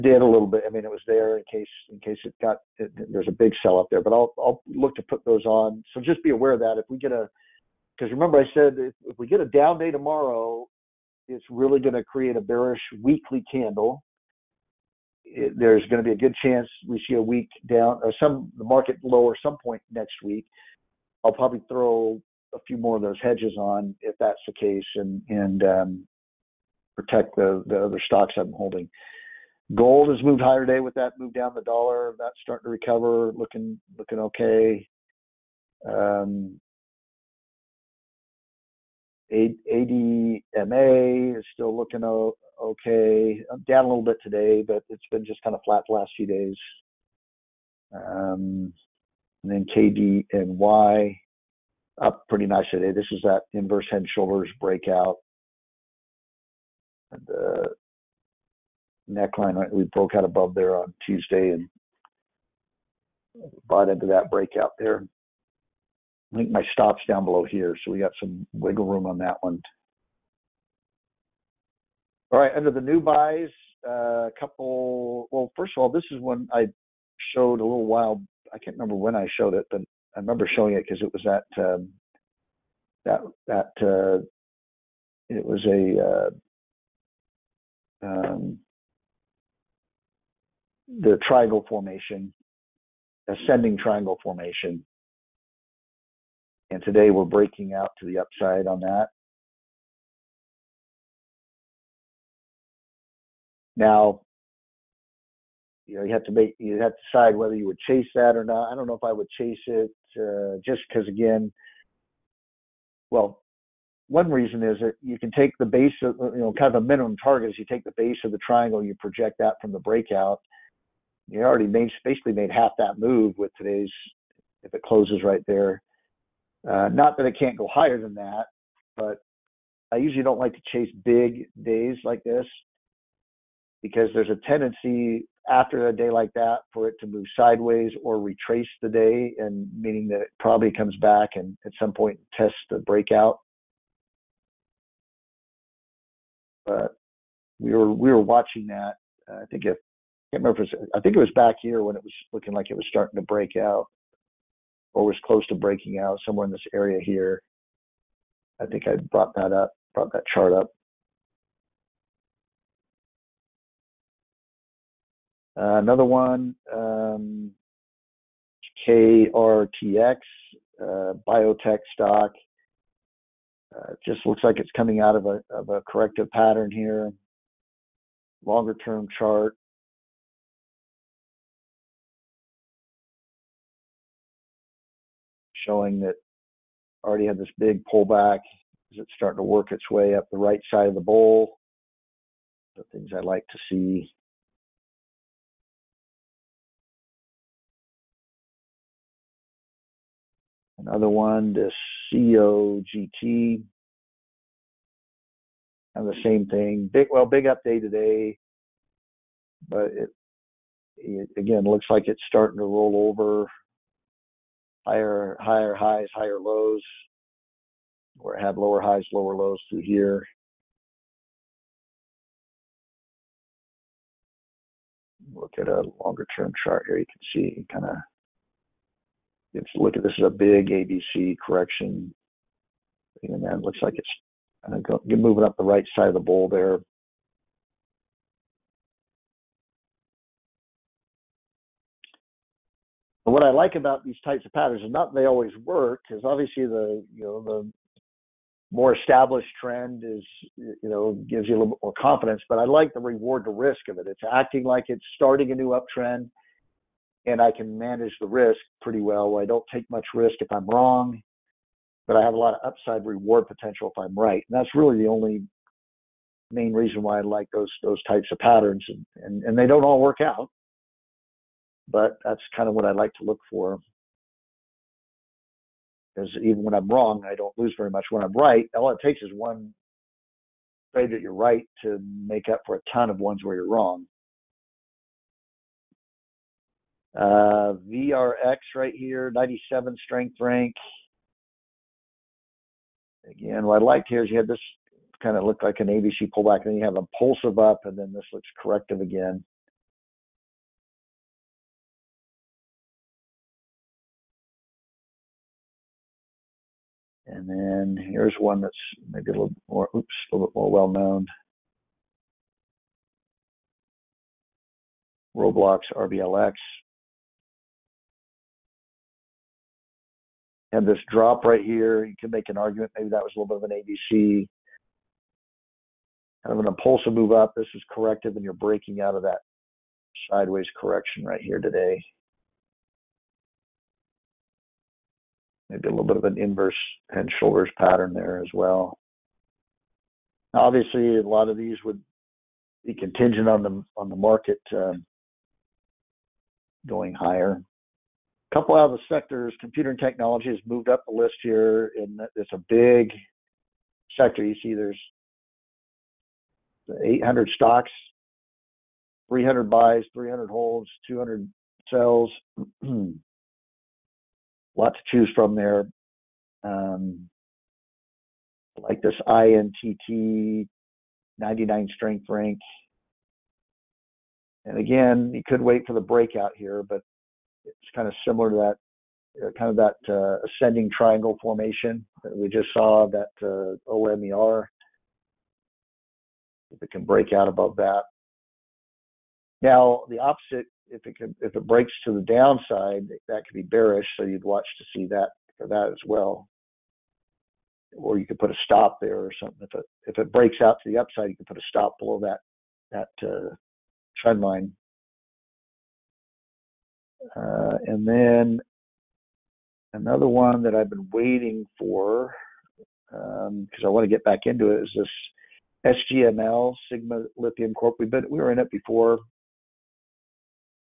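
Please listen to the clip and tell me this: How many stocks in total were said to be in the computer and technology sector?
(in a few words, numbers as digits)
800.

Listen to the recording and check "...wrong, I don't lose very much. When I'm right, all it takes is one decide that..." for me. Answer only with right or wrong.
wrong.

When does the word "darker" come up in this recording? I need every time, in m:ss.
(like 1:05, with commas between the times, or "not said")
not said.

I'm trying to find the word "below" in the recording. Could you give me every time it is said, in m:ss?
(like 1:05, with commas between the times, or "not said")
1:07, 6:41.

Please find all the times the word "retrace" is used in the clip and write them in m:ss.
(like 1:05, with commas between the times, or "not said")
2:18.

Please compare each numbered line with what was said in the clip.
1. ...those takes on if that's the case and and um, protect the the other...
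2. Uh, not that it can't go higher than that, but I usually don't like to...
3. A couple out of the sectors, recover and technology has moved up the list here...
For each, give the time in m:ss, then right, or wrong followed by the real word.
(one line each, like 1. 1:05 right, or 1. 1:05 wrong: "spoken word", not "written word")
1. 0:23 wrong: "hedges", not "takes"
2. 2:06 right
3. 5:48 wrong: "computer", not "recover".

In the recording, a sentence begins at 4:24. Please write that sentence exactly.
And that's really the only main reason why I like those those types of patterns.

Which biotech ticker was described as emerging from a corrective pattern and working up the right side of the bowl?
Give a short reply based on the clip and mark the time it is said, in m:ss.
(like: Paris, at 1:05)
KRTX, at 2:48.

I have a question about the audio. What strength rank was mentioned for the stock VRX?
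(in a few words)
97.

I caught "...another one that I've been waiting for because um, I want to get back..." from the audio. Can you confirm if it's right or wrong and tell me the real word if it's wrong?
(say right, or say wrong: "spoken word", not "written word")
right.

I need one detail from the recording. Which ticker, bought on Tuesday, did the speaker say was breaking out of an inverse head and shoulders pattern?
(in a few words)
KDNY.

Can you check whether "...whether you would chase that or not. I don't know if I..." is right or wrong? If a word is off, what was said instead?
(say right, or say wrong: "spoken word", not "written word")
right.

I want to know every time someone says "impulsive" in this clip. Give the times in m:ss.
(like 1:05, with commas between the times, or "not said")
4:56, 5:26.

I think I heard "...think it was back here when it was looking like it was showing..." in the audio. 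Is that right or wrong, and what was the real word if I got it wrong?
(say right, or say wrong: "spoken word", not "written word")
wrong: "starting", not "showing".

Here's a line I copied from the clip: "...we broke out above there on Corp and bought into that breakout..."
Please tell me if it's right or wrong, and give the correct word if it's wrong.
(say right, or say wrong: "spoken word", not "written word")
wrong: "Tuesday", not "Corp".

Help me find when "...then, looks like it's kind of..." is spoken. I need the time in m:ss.
3:53.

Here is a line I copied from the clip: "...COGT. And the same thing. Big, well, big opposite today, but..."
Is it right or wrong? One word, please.
wrong.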